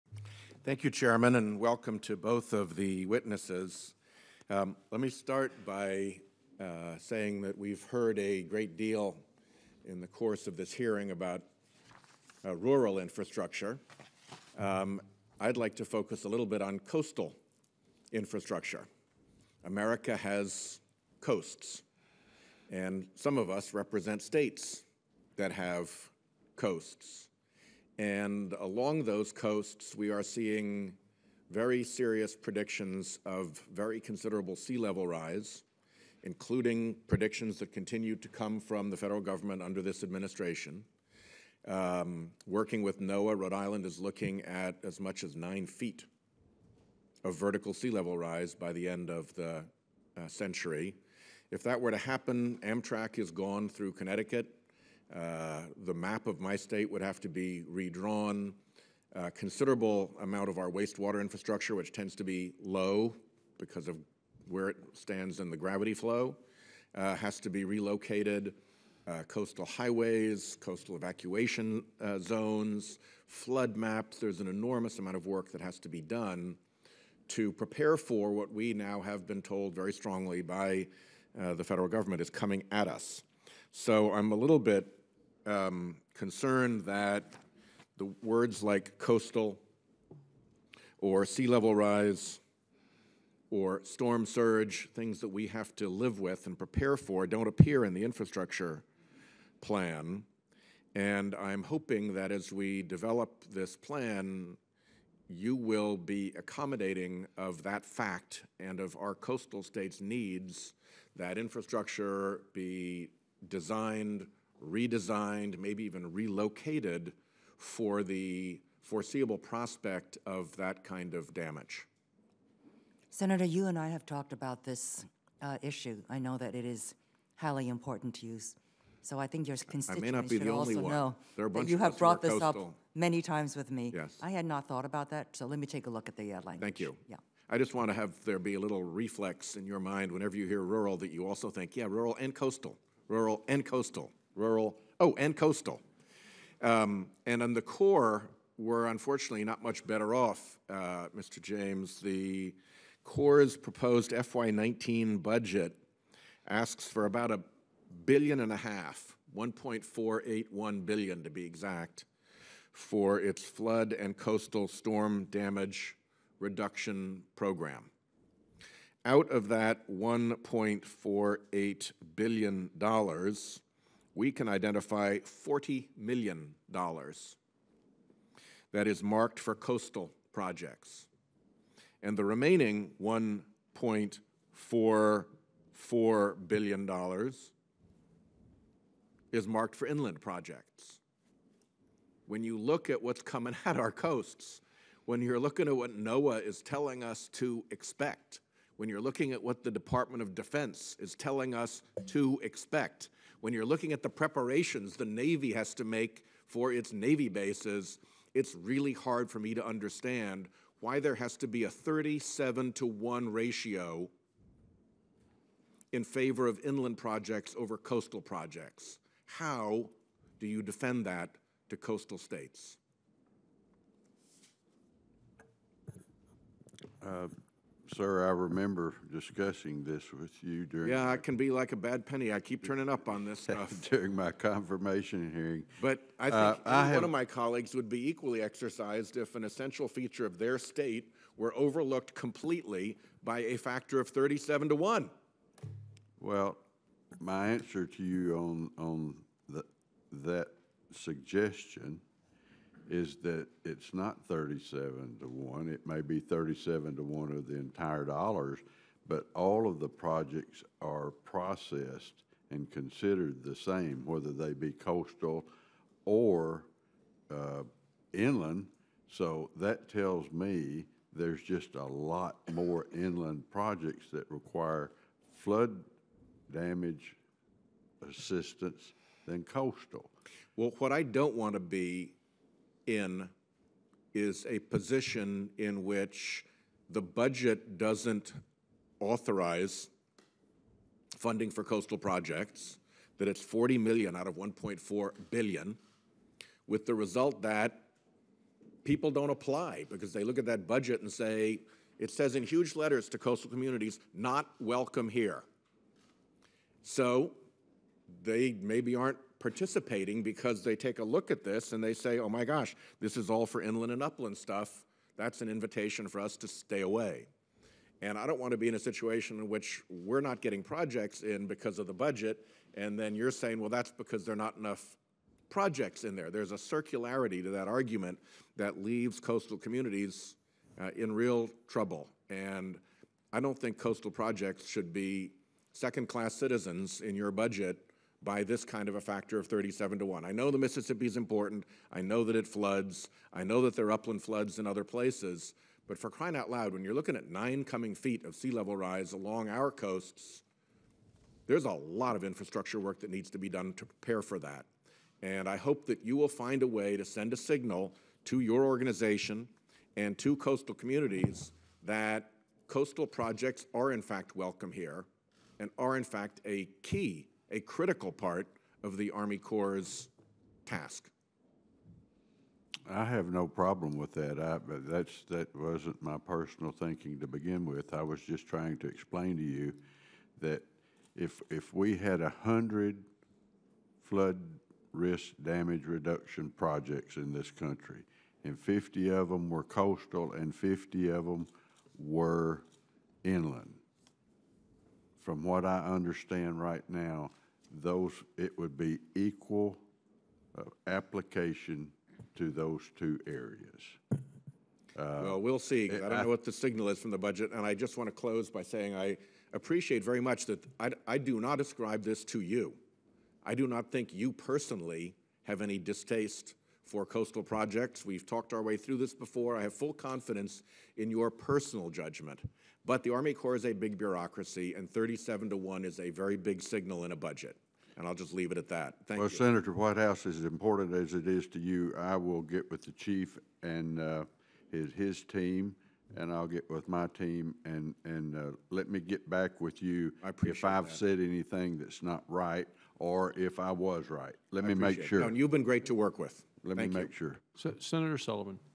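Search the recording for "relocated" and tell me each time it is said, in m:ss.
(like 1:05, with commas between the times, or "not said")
1:07, 1:56.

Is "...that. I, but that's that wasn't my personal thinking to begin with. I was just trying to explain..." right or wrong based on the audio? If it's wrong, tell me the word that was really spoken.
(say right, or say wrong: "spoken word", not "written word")
right.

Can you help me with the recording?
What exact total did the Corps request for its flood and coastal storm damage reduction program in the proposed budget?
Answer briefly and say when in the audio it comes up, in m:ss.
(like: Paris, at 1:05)
$1.481 billion, at 2:39.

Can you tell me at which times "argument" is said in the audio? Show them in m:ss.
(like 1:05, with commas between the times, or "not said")
5:27.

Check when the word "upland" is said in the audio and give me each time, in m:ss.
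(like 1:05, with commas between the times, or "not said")
5:14, 5:43.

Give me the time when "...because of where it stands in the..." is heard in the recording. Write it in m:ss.
1:03.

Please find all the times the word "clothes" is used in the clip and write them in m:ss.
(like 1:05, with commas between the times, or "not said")
not said.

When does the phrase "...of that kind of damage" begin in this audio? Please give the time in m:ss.
2:00.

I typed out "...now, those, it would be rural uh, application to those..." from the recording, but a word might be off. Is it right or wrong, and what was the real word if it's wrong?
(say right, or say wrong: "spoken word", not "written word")
wrong: "equal", not "rural".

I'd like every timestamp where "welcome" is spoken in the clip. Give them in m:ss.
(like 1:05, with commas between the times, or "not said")
0:01, 5:04, 6:04.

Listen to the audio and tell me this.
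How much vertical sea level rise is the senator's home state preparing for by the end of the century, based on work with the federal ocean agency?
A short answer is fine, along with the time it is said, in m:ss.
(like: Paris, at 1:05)
9 feet, at 0:45.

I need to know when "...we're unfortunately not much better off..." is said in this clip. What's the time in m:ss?
2:28.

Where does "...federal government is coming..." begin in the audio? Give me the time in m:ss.
1:21.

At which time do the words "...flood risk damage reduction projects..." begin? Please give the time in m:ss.
6:24.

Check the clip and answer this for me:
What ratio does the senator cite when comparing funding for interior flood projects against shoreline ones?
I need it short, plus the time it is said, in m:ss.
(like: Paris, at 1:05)
37 to 1, at 3:31.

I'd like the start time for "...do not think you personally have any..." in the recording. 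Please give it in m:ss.
6:53.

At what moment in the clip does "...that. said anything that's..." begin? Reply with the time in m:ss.
7:20.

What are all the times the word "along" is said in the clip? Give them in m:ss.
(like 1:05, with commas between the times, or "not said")
0:28, 5:49.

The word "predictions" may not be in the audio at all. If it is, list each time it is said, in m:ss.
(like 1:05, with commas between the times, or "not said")
0:32, 0:37.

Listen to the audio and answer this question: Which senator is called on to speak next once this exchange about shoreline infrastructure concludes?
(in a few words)
Senator Sullivan.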